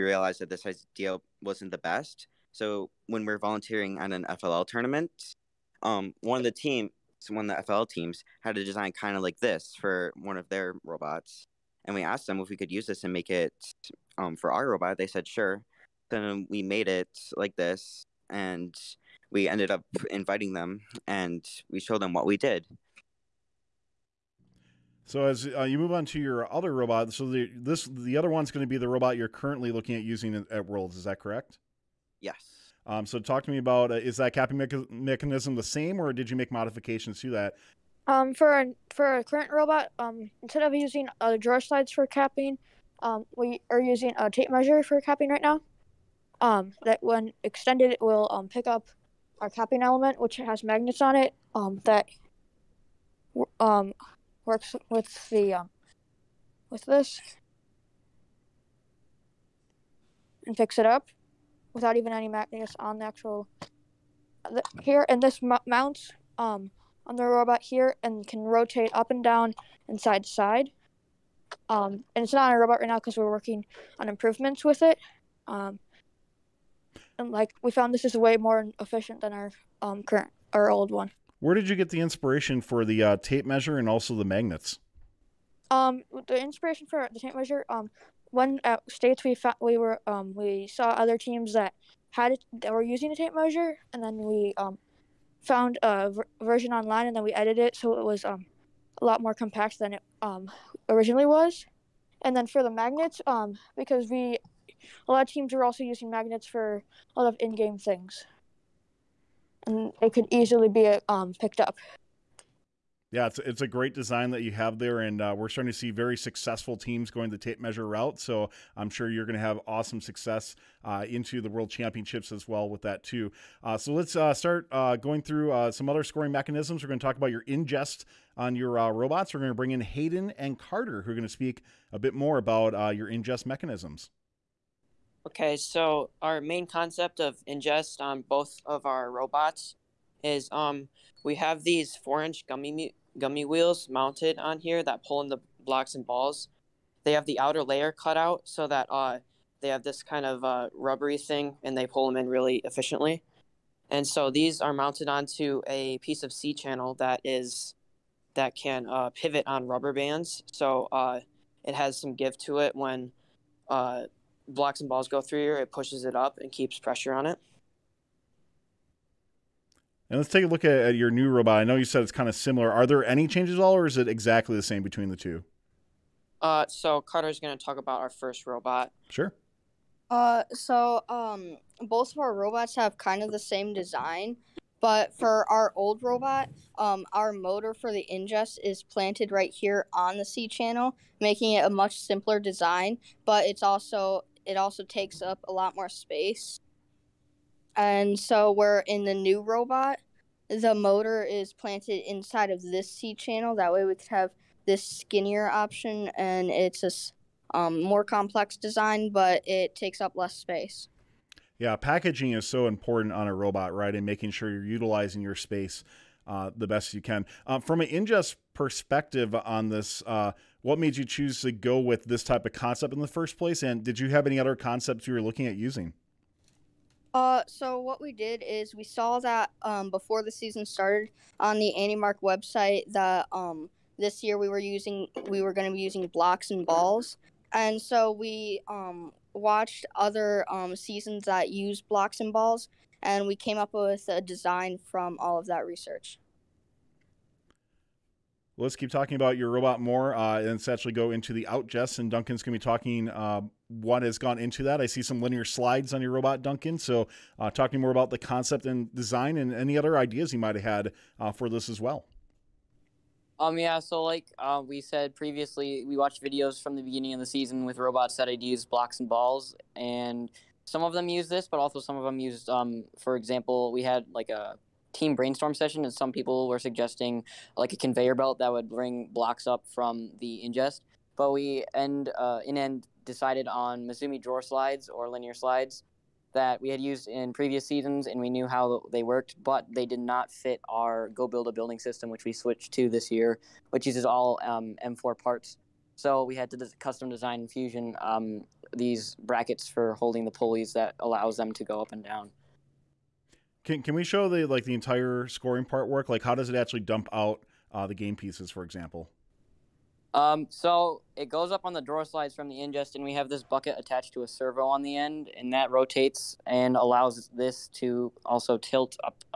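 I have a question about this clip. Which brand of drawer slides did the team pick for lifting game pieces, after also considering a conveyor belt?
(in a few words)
Misumi.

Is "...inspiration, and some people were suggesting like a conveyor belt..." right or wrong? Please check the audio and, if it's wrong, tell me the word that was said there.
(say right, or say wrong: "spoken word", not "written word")
wrong: "session", not "inspiration".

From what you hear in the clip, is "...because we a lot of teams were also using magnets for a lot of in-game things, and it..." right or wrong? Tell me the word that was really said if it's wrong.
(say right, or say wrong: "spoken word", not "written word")
right.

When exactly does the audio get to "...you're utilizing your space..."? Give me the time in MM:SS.
03:34.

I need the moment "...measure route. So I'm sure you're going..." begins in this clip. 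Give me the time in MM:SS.
01:57.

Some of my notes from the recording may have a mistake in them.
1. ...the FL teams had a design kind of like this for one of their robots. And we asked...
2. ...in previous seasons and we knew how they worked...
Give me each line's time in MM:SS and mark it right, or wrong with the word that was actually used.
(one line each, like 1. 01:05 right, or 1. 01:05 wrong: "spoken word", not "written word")
1. 00:07 right
2. 04:47 right.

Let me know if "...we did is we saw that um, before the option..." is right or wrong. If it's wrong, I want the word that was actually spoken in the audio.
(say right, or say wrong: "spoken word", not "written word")
wrong: "season", not "option".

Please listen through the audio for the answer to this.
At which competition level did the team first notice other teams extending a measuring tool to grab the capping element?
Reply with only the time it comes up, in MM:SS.
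01:28.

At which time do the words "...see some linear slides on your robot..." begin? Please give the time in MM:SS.
04:14.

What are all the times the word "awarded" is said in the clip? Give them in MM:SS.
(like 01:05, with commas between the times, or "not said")
not said.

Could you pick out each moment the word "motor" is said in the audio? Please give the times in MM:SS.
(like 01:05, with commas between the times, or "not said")
03:07, 03:20.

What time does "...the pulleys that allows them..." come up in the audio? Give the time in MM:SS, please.
05:00.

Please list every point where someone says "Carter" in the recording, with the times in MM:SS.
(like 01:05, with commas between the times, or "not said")
02:10, 02:57.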